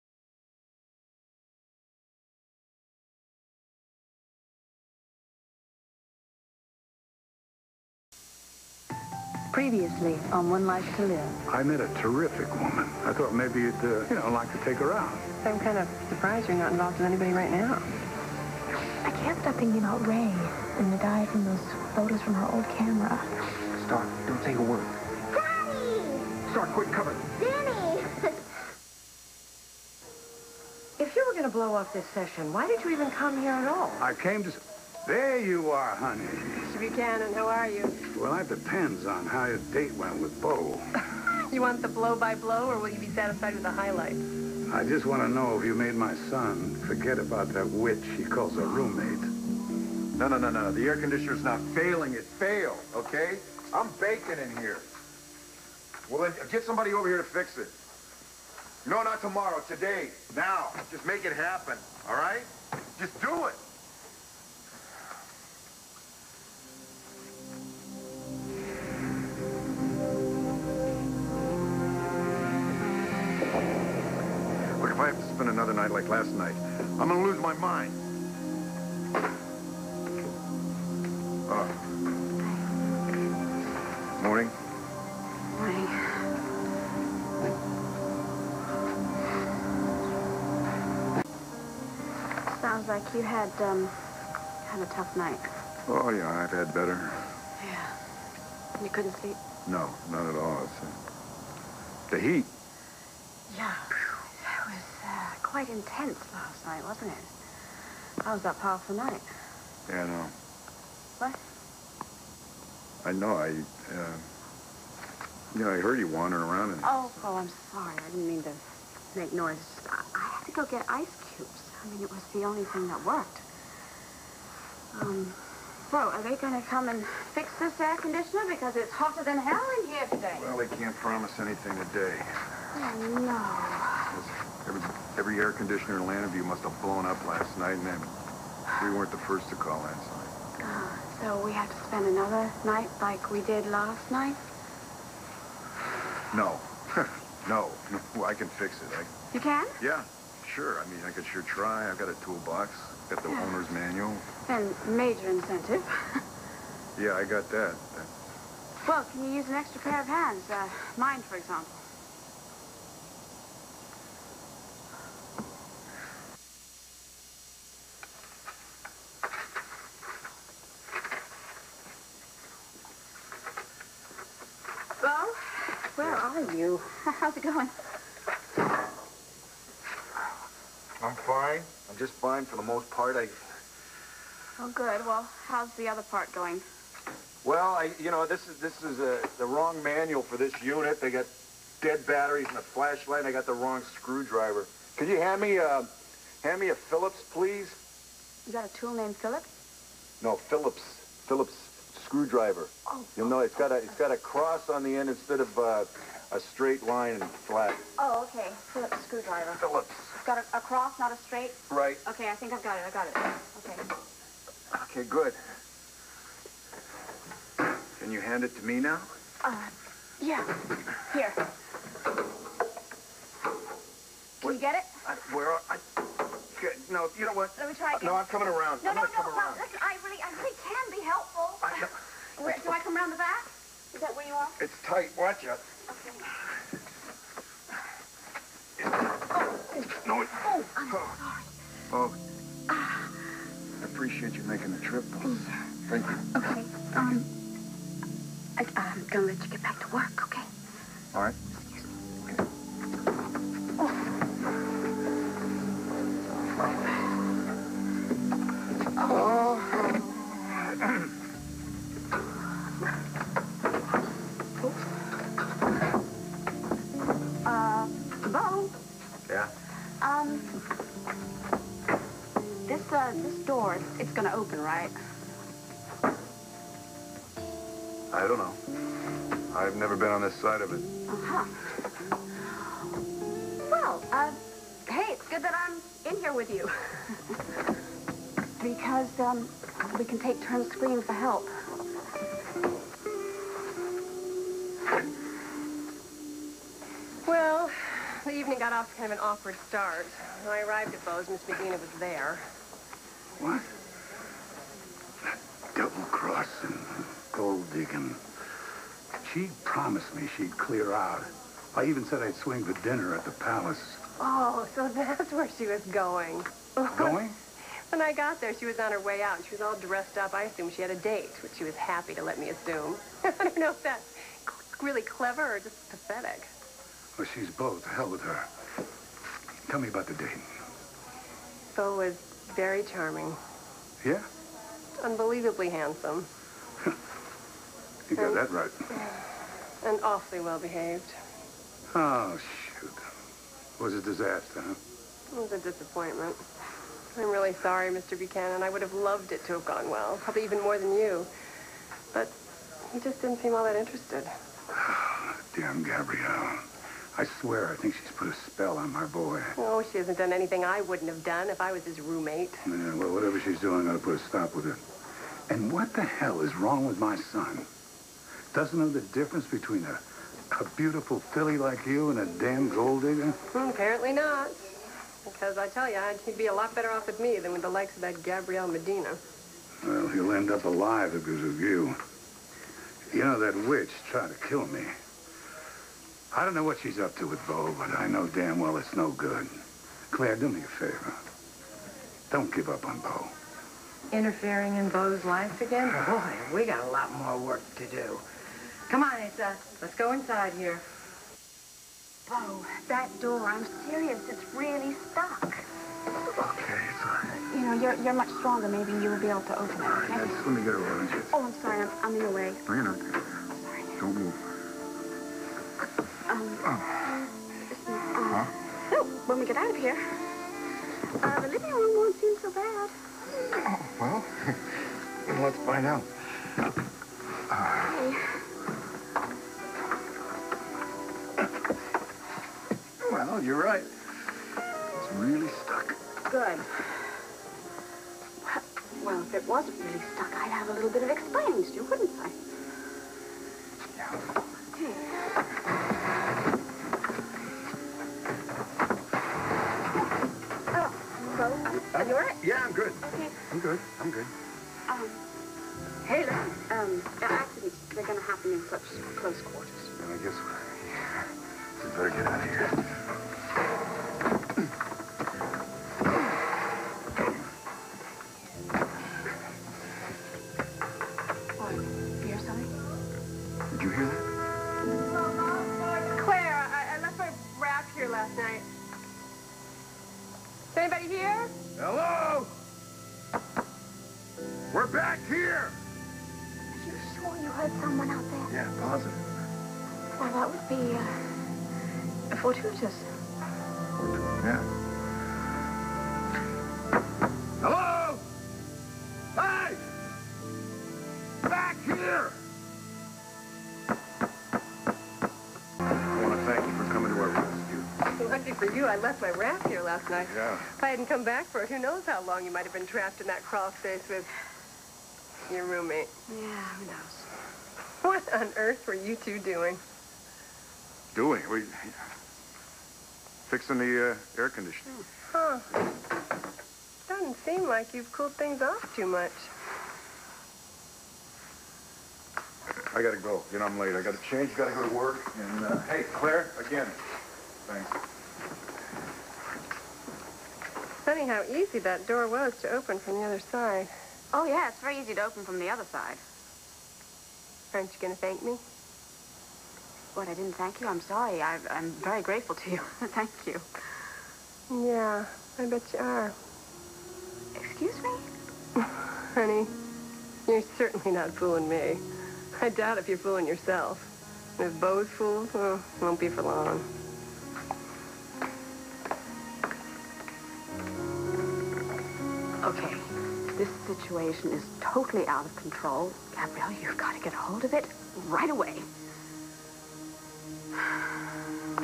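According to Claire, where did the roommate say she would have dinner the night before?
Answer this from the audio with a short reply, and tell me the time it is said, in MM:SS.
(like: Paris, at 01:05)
The Palace, at 05:13.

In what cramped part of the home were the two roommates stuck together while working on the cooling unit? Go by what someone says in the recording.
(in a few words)
Crawl space.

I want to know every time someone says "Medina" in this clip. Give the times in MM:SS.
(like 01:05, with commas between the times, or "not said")
05:01, 06:18.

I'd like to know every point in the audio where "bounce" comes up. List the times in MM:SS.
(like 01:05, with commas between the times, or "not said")
not said.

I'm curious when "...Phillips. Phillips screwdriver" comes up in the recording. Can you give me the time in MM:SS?
03:20.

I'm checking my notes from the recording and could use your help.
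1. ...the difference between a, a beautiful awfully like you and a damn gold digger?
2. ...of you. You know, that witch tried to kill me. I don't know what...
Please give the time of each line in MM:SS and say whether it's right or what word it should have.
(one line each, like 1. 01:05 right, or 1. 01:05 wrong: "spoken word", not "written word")
1. 06:08 wrong: "filly", not "awfully"
2. 06:21 right.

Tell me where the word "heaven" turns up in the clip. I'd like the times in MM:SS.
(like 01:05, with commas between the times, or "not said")
not said.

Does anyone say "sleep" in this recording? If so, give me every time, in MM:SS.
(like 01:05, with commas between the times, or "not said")
01:39.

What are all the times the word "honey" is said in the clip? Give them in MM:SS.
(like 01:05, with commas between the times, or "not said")
00:35, 09:18.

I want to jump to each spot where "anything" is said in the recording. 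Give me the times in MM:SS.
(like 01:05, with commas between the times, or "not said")
02:11, 06:00.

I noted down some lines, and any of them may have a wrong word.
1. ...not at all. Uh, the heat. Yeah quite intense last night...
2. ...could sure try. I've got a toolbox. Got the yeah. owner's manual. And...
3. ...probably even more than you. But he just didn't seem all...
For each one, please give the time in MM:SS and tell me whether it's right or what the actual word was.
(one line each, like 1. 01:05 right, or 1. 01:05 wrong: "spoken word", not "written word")
1. 01:40 right
2. 02:31 right
3. 05:50 right.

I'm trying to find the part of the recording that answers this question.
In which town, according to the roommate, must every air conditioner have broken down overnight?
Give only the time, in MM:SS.
02:16.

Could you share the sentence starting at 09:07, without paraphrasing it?
Aren't you going to thank me?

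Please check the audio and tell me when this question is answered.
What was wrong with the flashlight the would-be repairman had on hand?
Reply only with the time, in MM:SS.
03:11.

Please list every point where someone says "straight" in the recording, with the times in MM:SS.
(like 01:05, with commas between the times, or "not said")
03:26, 03:31.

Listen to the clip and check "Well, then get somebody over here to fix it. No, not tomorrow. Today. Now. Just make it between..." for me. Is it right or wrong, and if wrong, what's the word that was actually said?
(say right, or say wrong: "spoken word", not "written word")
wrong: "happen", not "between".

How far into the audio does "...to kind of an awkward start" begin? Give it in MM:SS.
04:58.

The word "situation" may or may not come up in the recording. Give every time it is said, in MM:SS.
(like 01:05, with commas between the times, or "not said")
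09:33.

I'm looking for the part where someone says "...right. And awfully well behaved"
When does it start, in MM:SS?
05:38.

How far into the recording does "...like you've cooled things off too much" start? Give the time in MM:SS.
08:47.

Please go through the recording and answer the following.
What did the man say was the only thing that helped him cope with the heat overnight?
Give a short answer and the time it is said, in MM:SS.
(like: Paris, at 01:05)
Ice cubes, at 02:00.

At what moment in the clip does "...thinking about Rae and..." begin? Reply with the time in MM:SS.
00:19.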